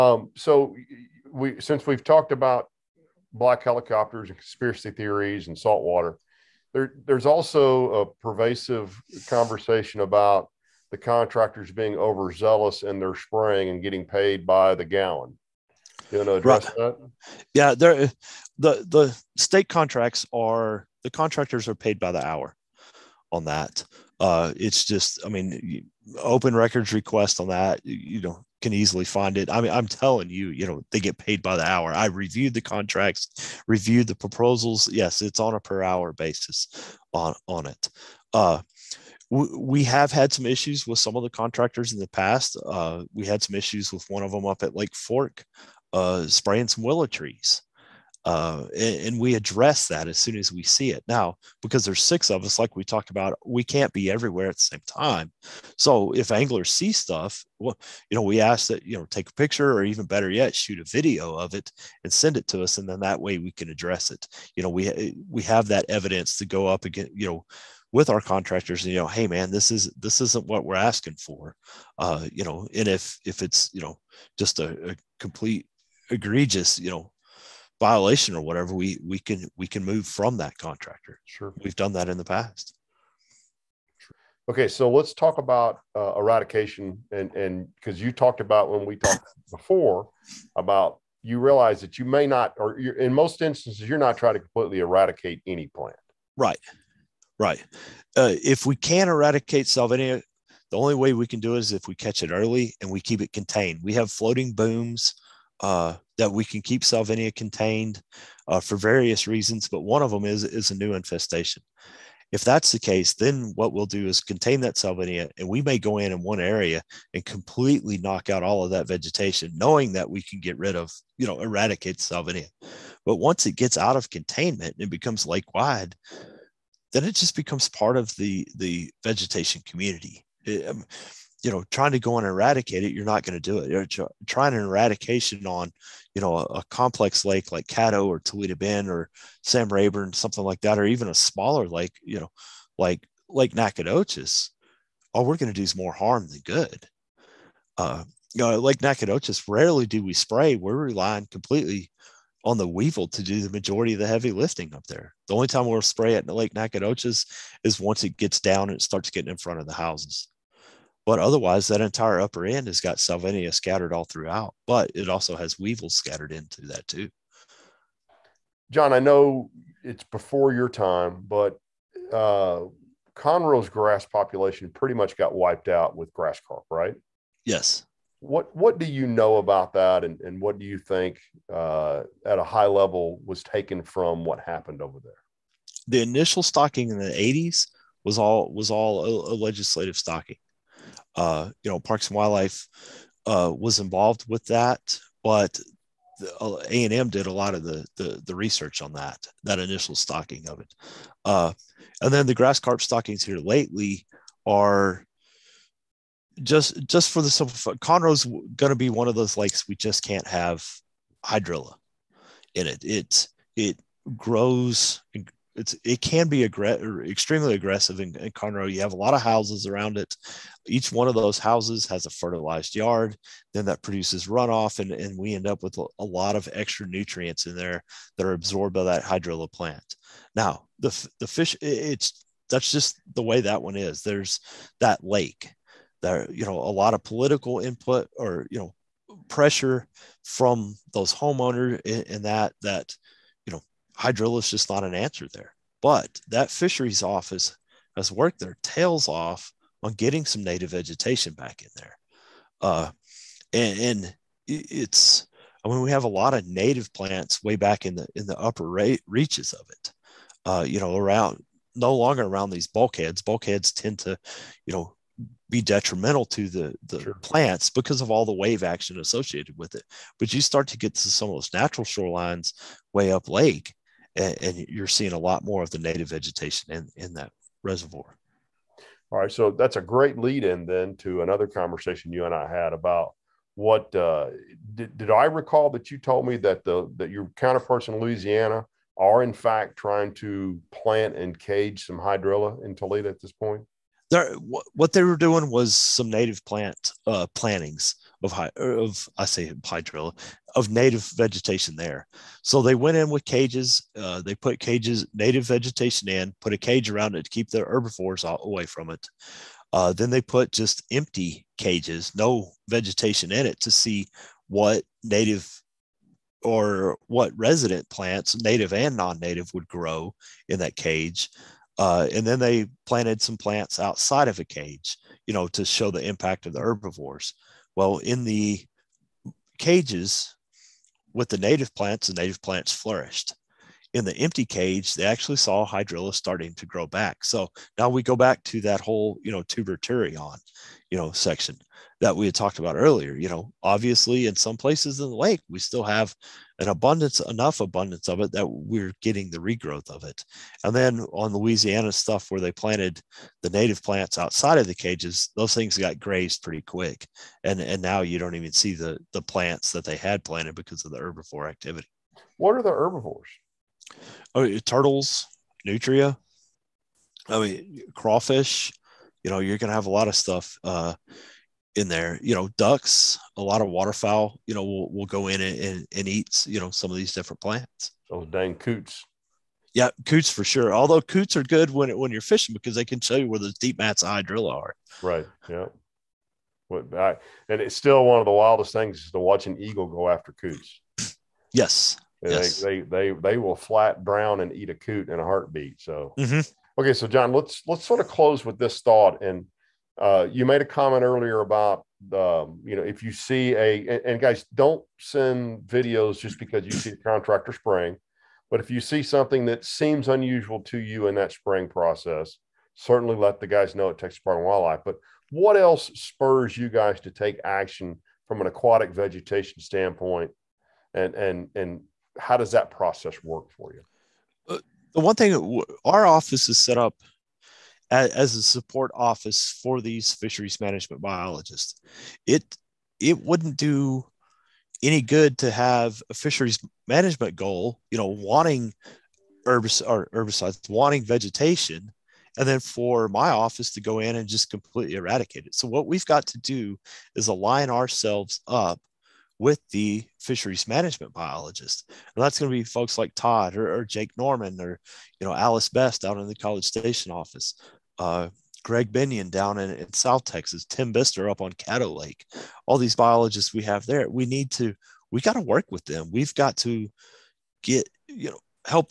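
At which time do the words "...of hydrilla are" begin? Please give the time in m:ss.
6:24.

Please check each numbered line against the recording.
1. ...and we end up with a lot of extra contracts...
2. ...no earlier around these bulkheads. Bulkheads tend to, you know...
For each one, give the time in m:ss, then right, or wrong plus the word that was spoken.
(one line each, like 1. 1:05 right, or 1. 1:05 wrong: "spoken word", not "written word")
1. 3:44 wrong: "nutrients", not "contracts"
2. 4:21 wrong: "longer", not "earlier".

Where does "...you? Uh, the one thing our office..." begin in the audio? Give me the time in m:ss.
7:03.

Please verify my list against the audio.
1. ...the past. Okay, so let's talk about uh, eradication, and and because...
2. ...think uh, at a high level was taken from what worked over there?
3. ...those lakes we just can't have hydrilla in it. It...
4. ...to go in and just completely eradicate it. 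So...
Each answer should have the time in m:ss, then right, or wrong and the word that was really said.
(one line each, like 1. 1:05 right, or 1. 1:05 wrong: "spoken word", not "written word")
1. 1:22 right
2. 3:00 wrong: "happened", not "worked"
3. 3:29 right
4. 7:23 right.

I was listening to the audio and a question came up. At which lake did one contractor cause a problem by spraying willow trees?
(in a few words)
Lake Fork.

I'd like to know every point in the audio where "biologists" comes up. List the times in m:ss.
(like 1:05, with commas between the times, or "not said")
7:11, 7:31, 7:42.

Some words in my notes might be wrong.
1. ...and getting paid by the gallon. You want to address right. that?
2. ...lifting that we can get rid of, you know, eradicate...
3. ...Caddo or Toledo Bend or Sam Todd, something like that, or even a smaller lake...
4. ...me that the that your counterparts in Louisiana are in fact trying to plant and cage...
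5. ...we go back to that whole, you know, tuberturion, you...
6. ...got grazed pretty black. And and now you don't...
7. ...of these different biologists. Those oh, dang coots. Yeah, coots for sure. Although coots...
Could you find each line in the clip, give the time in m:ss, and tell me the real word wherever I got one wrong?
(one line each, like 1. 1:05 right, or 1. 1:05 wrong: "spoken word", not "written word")
1. 0:13 right
2. 1:59 wrong: "knowing", not "lifting"
3. 2:17 wrong: "Rayburn", not "Todd"
4. 4:46 right
5. 5:37 right
6. 5:55 wrong: "quick", not "black"
7. 6:16 wrong: "plants", not "biologists".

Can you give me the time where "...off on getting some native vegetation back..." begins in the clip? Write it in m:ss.
4:09.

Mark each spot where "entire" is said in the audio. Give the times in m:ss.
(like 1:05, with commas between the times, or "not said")
2:41.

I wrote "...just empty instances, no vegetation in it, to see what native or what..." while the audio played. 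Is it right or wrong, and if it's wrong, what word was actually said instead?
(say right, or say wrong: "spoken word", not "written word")
wrong: "cages", not "instances".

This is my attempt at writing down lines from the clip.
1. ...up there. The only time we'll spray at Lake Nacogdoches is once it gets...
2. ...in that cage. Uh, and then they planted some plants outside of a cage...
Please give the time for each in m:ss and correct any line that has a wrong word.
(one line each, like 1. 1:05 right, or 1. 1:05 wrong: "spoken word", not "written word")
1. 2:34 right
2. 5:20 right.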